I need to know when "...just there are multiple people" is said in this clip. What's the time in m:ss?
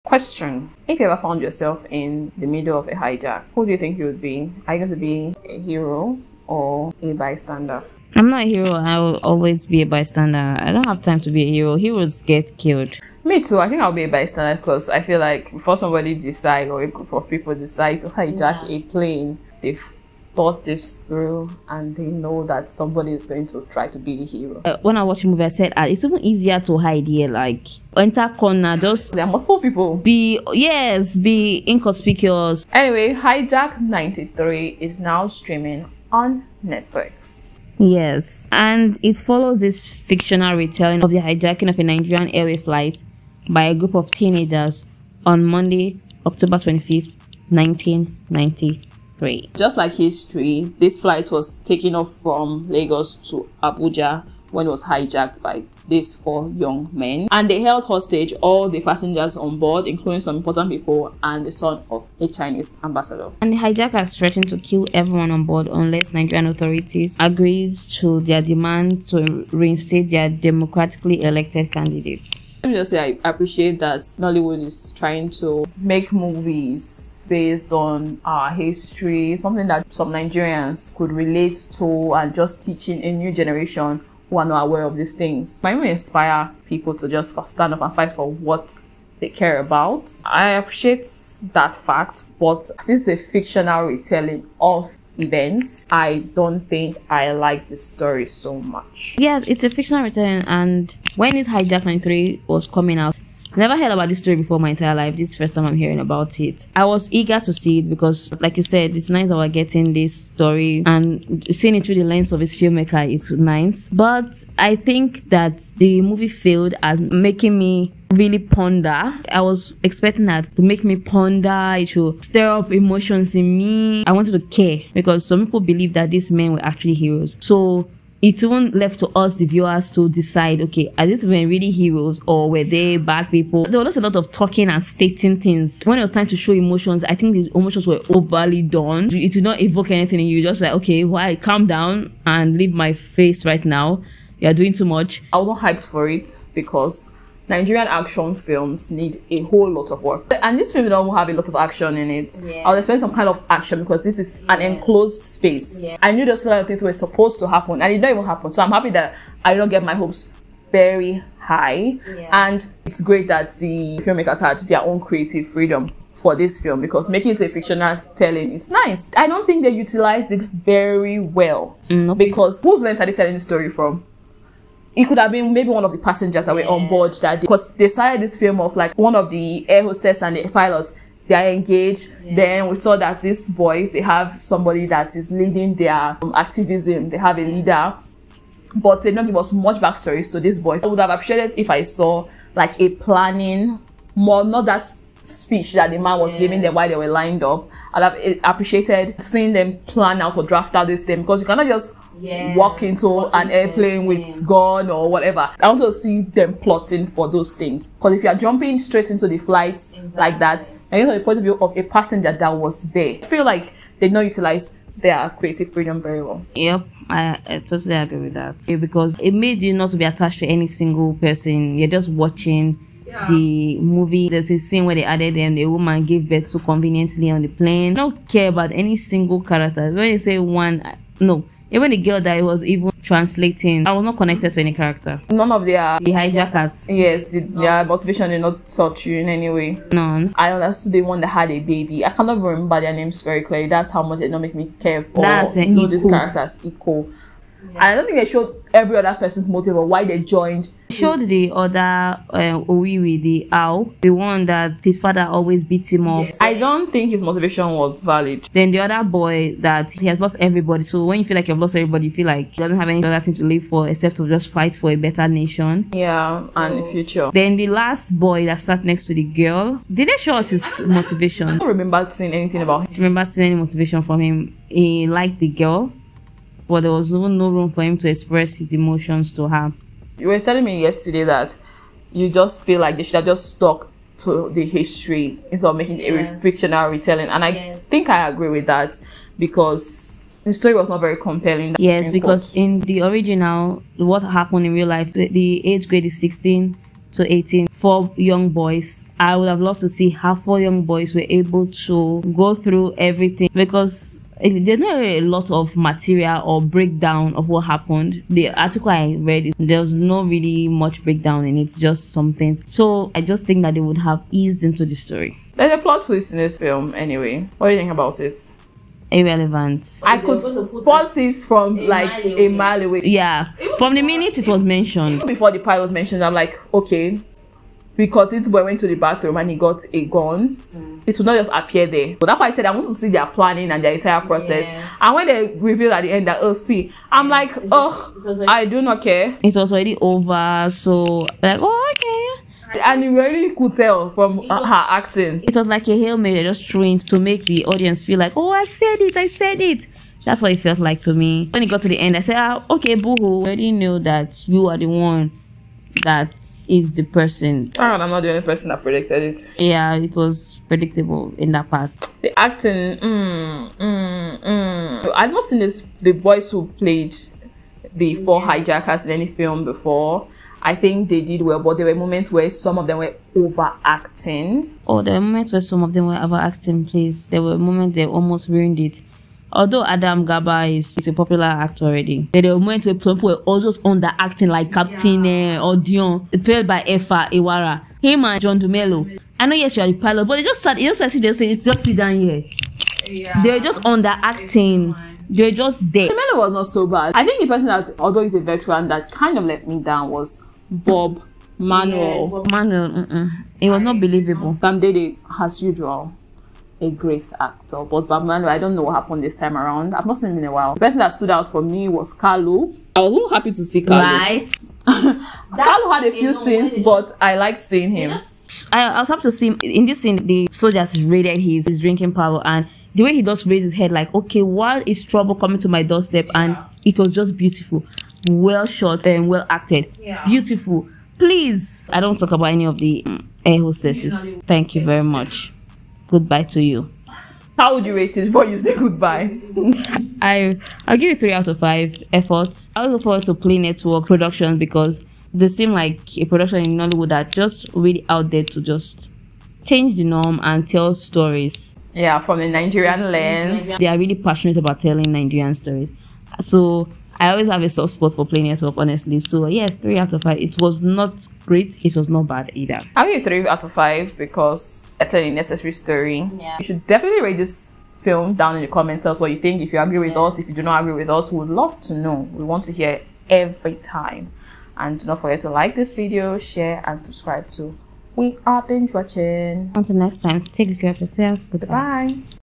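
0:28.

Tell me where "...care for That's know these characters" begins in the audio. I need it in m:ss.
4:04.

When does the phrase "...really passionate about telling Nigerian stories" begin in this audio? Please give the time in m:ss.
7:33.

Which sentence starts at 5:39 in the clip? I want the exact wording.
It was already over, so like, oh okay.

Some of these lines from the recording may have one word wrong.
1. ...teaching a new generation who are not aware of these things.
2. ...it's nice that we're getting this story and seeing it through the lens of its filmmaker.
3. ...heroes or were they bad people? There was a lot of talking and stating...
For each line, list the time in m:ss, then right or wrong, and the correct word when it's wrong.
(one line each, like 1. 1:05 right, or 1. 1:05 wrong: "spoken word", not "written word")
1. 1:22 right
2. 1:48 right
3. 2:11 right.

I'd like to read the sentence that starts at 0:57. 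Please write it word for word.
And they held hostage all the passengers on board, including some important people and the son of a Chinese ambassador.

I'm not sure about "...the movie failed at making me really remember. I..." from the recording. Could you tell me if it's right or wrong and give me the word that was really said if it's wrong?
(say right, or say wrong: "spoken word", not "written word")
wrong: "ponder", not "remember".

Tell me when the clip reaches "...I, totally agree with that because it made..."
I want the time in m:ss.
3:37.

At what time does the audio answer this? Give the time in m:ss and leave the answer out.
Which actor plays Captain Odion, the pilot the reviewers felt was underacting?
6:26.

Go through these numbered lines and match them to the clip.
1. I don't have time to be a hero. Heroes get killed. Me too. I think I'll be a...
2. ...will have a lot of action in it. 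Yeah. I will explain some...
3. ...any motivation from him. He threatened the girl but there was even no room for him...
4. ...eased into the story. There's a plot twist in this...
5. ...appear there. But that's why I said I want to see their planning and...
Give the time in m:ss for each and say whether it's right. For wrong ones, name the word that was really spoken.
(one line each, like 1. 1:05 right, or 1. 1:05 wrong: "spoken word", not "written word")
1. 0:10 right
2. 2:30 right
3. 4:33 wrong: "liked", not "threatened"
4. 5:14 right
5. 5:31 right.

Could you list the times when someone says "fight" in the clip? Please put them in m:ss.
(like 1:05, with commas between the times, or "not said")
1:27, 4:24.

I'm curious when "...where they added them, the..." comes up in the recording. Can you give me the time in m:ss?
3:44.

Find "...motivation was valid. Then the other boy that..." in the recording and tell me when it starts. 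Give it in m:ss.
4:17.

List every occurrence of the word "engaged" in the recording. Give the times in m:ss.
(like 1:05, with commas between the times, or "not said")
3:01.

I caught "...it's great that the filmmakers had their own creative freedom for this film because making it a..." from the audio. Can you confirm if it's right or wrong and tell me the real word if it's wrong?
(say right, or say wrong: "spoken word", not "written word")
right.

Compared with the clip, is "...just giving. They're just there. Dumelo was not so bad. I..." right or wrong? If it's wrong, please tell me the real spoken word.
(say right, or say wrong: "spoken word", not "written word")
wrong: "underacting", not "giving".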